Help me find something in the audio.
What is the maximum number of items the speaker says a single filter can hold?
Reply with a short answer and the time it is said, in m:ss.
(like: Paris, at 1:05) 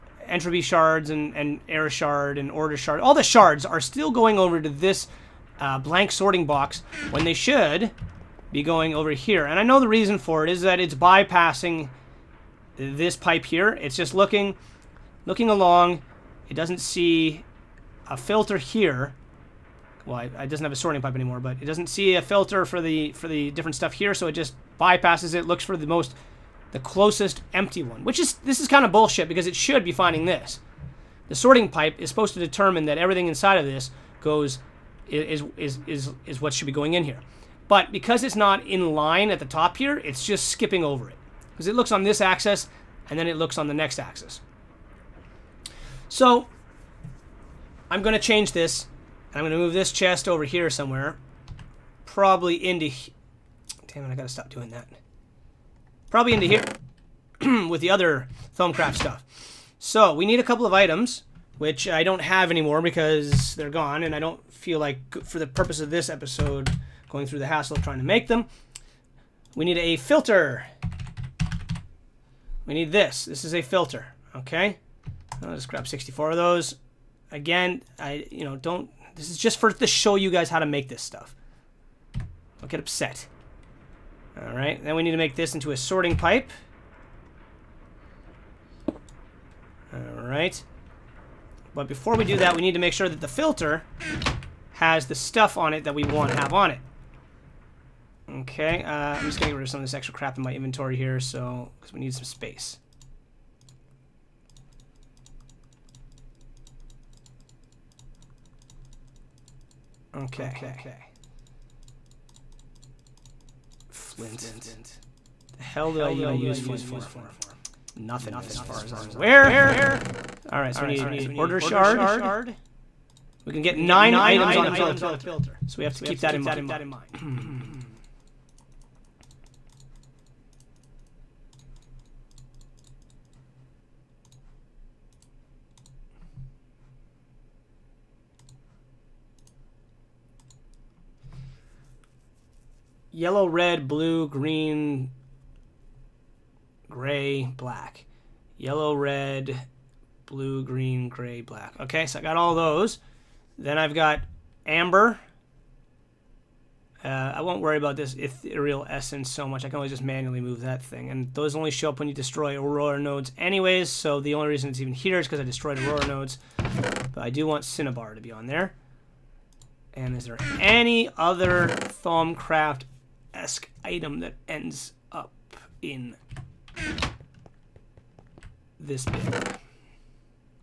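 9, at 2:03.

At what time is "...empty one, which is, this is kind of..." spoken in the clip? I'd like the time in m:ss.
0:27.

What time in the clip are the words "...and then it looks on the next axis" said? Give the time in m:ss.
0:43.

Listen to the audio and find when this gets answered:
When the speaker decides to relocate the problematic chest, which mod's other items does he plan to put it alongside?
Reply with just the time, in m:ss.
0:58.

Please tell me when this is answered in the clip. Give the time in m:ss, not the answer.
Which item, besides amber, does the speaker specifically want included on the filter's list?
2:47.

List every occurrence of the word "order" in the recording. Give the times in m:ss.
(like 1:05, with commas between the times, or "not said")
0:02, 2:01.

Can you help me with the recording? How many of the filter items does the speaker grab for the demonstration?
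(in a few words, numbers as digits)
64.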